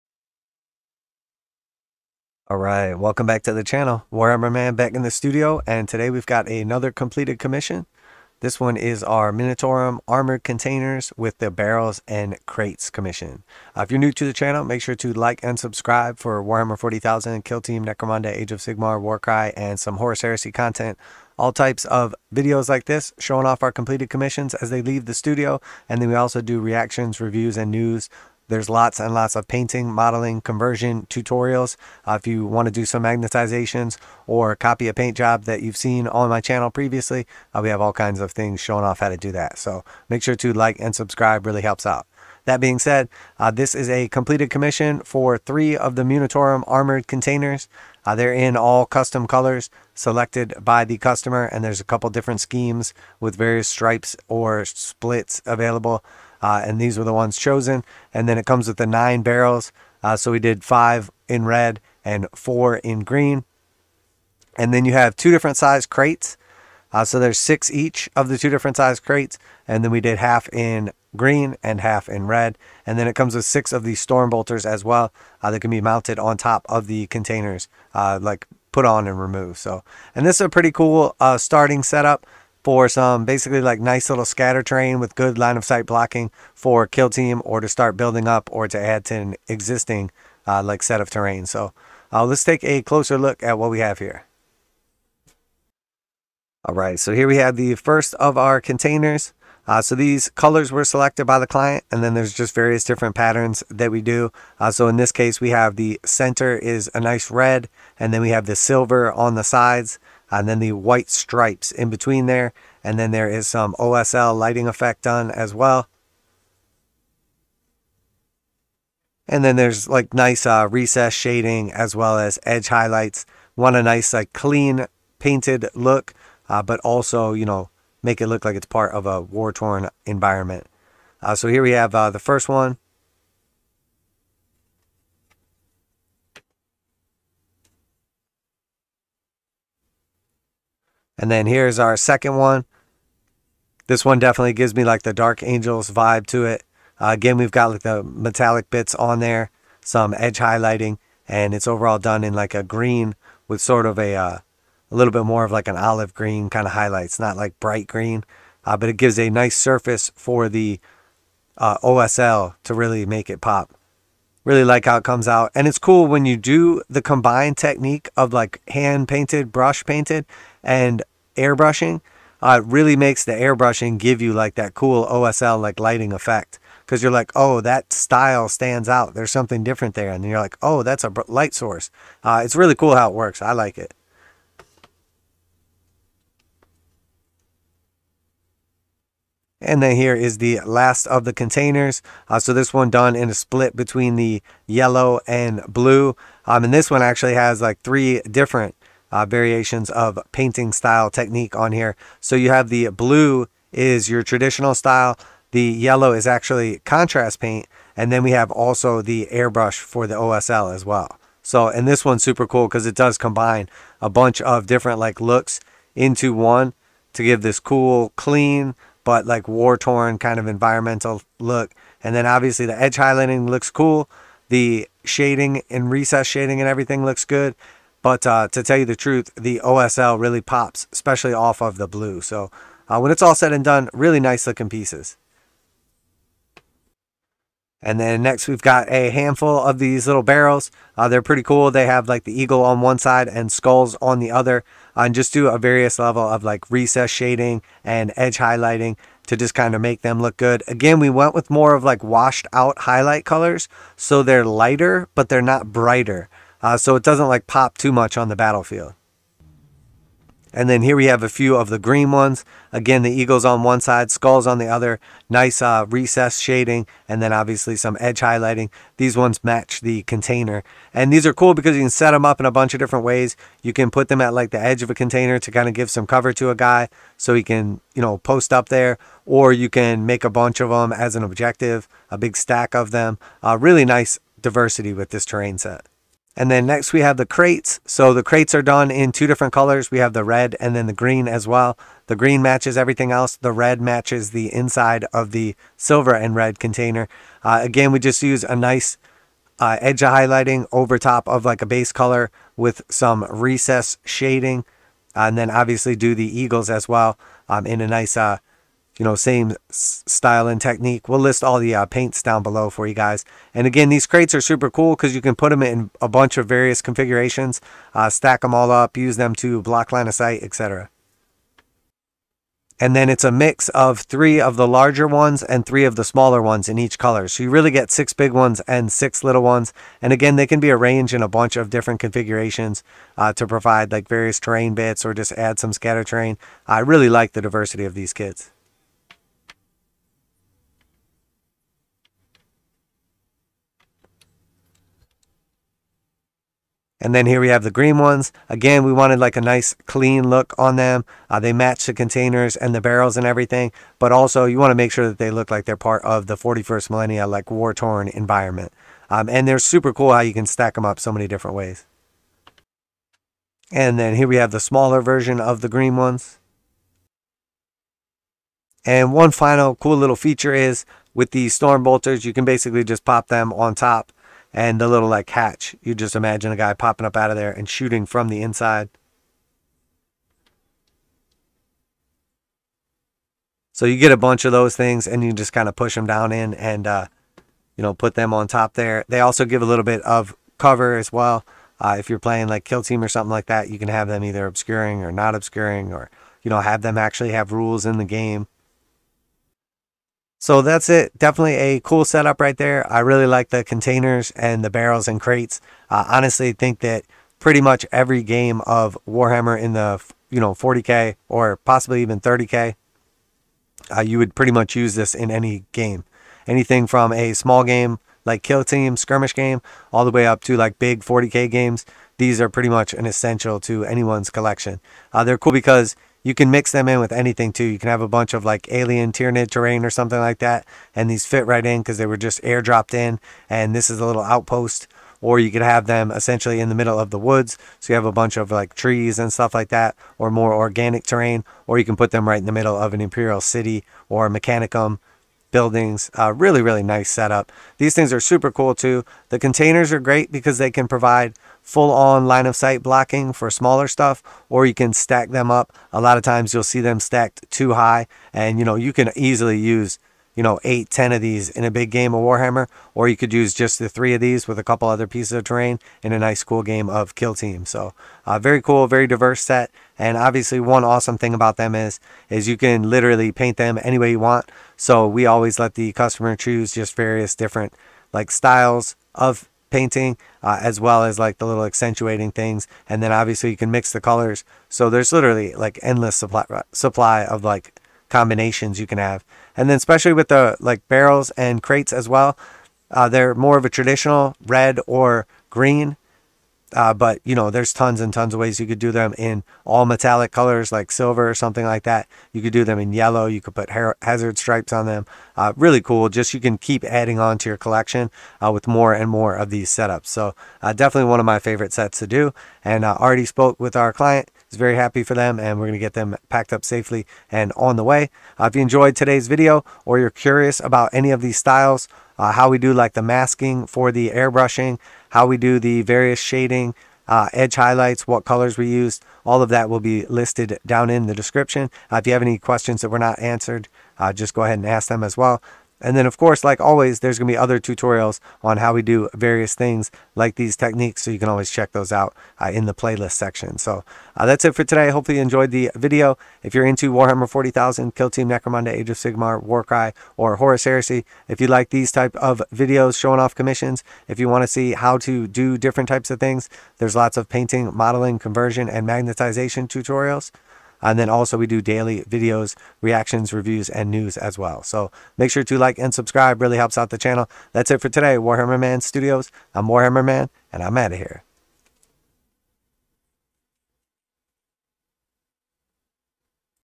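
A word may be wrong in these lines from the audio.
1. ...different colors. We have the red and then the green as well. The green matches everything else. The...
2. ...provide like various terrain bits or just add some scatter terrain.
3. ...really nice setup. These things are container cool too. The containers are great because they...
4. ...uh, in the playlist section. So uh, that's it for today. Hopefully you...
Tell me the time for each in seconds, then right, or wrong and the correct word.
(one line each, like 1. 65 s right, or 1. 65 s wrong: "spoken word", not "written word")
1. 289 s right
2. 333 s right
3. 446 s wrong: "super", not "container"
4. 542 s right.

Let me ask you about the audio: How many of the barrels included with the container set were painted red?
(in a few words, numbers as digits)
5.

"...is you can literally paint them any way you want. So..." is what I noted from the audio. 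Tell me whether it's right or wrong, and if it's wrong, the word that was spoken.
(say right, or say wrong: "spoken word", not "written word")
right.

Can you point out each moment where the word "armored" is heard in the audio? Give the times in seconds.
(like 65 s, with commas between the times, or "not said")
10 s, 46 s.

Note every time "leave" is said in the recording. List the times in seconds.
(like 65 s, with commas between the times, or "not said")
24 s.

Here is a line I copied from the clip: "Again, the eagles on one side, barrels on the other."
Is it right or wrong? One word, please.
wrong.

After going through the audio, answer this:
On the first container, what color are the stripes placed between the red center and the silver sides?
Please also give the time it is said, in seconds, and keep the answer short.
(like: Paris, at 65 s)
White, at 110 s.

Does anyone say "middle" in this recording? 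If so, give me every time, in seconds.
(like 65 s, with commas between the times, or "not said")
436 s, 442 s.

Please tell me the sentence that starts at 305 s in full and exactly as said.
Uh, and then obviously do the eagles as well um, in a nice uh, you know, same style and technique.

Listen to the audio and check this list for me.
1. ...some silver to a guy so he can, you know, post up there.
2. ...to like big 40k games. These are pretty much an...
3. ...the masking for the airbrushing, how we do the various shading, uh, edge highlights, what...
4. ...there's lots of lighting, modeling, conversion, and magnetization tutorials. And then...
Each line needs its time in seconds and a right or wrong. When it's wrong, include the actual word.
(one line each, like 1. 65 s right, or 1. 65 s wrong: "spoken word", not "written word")
1. 275 s wrong: "cover", not "silver"
2. 420 s right
3. 522 s right
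4. 556 s wrong: "painting", not "lighting".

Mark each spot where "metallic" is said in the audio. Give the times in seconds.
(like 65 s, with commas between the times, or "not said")
148 s, 499 s.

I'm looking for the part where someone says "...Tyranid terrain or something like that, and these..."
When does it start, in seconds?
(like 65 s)
429 s.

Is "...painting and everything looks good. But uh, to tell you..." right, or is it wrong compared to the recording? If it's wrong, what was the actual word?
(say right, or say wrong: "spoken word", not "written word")
wrong: "shading", not "painting".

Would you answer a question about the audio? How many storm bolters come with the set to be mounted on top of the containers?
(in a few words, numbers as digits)
6.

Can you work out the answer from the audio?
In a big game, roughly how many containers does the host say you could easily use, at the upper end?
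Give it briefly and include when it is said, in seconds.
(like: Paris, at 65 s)
10, at 460 s.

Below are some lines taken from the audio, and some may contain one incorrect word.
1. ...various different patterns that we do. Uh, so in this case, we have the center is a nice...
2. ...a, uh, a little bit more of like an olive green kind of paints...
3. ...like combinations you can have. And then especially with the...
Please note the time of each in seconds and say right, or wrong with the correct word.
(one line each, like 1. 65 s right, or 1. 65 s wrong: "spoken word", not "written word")
1. 102 s right
2. 153 s wrong: "highlights", not "paints"
3. 487 s right.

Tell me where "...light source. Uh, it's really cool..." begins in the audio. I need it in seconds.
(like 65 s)
181 s.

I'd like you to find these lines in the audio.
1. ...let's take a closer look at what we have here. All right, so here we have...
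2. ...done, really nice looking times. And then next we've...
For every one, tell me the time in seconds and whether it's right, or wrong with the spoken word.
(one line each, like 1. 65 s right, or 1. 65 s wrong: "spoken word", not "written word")
1. 92 s right
2. 233 s wrong: "pieces", not "times".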